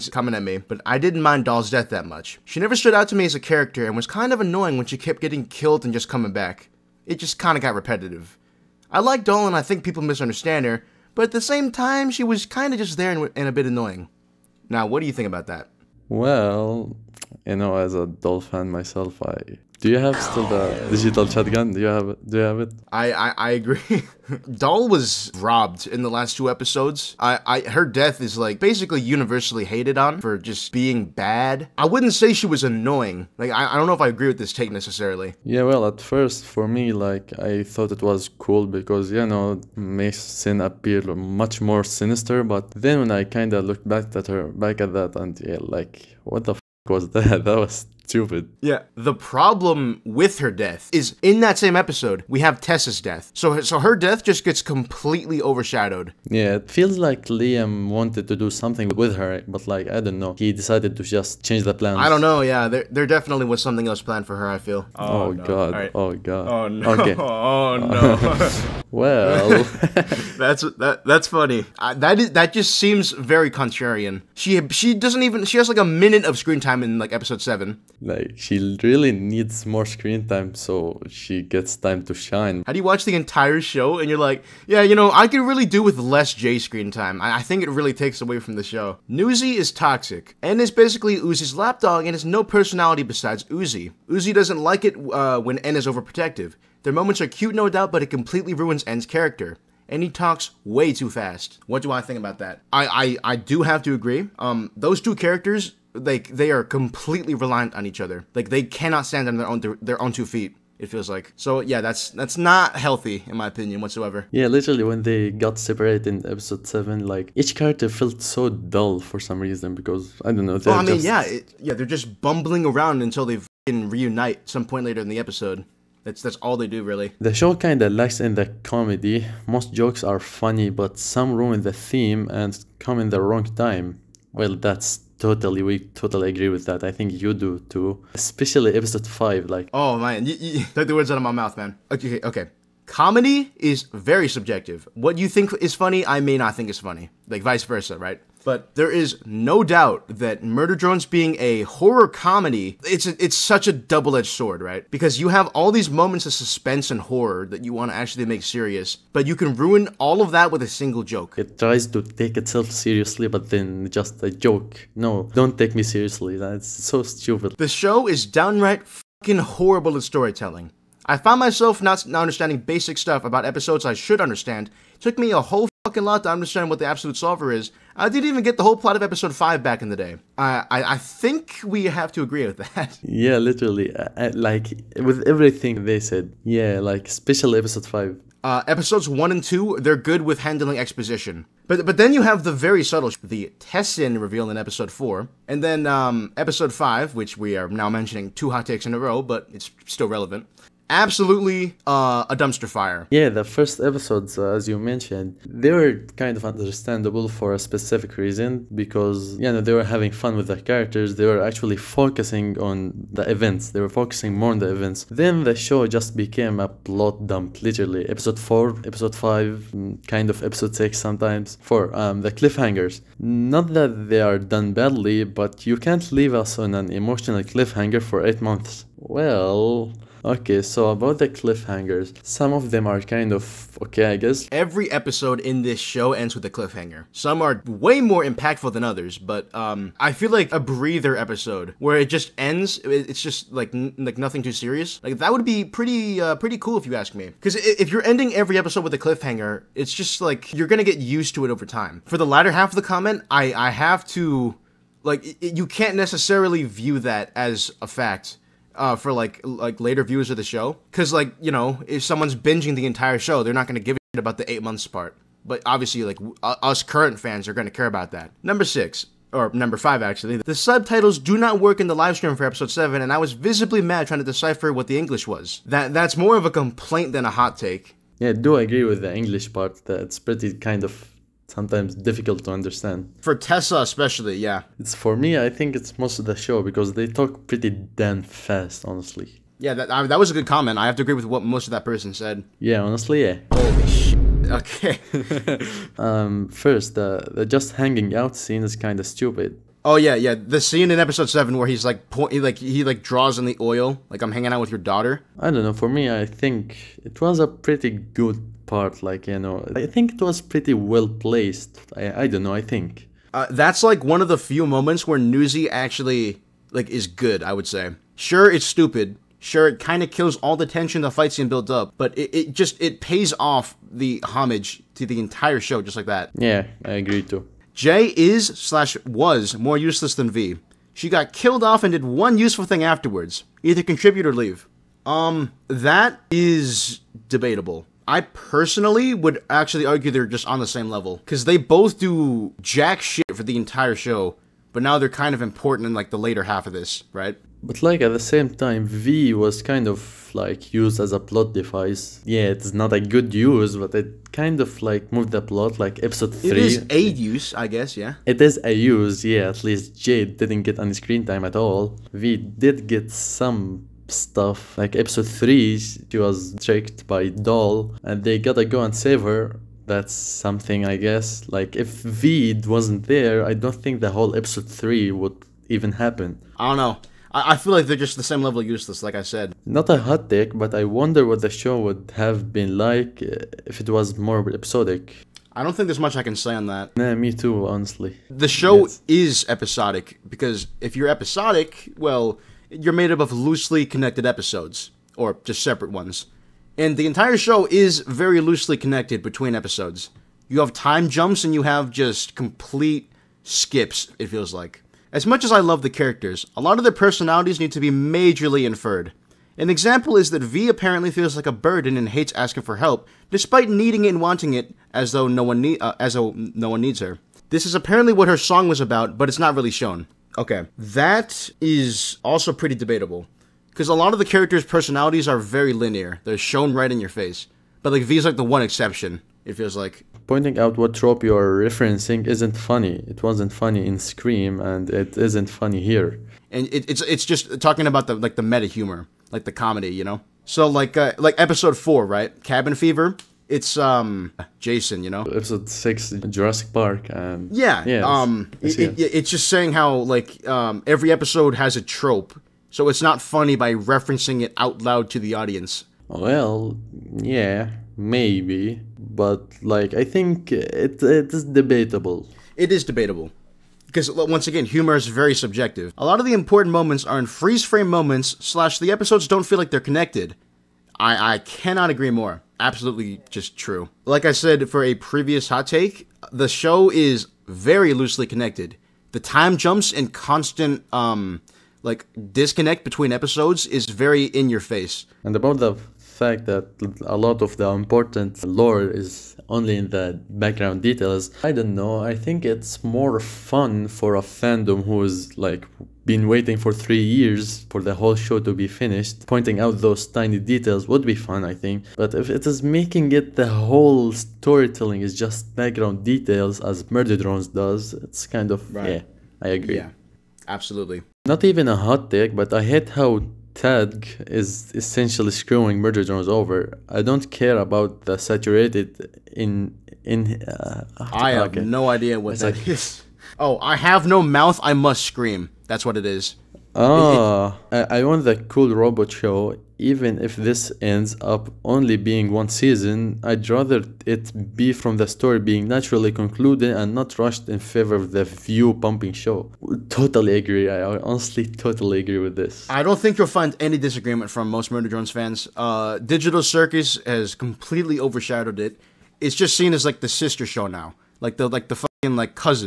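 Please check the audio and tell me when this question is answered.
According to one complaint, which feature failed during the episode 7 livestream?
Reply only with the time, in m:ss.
4:30.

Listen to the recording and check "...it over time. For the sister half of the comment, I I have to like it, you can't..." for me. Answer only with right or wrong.
wrong.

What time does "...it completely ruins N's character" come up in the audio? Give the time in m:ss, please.
1:38.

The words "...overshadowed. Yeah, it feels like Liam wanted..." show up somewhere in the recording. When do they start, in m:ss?
0:55.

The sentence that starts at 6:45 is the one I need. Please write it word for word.
As much as I love the characters, a lot of their personalities need to be majorly inferred.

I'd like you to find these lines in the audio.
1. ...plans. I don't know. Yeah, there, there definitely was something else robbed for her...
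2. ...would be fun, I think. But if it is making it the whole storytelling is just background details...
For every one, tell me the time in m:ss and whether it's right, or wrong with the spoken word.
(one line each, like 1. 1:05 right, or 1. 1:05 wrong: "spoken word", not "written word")
1. 1:01 wrong: "planned", not "robbed"
2. 8:20 right.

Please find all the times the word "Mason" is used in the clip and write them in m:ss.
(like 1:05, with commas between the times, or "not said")
0:39.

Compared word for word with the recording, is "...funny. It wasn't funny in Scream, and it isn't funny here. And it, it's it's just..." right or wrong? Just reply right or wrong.
right.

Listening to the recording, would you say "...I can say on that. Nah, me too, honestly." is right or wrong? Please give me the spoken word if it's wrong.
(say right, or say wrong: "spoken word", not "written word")
right.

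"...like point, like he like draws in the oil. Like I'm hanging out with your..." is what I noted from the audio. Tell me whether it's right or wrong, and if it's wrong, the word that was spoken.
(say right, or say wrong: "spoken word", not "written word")
right.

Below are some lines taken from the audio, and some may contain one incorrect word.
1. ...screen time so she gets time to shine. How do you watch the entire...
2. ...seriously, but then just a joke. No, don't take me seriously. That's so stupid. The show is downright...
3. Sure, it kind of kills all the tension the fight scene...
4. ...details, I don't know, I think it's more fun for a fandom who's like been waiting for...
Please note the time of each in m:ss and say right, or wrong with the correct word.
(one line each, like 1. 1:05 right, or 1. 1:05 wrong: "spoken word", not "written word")
1. 1:19 right
2. 2:42 right
3. 5:19 right
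4. 8:10 right.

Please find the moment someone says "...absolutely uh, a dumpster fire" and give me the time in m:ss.
3:20.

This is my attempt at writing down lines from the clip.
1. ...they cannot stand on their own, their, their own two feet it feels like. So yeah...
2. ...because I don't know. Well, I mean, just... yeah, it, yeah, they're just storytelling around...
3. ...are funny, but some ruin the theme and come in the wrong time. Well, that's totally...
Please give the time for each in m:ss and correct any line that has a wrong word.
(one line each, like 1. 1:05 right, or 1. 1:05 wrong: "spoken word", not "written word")
1. 1:48 right
2. 1:59 wrong: "bumbling", not "storytelling"
3. 2:10 right.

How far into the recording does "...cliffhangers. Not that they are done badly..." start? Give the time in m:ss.
3:42.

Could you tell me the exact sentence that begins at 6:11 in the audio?
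Like if Veed wasn't there, I don't think the whole episode three would even happen.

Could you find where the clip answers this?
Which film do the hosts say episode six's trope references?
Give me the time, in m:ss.
7:26.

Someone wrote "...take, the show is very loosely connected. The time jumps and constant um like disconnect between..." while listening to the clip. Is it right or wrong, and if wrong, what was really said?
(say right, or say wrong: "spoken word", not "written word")
right.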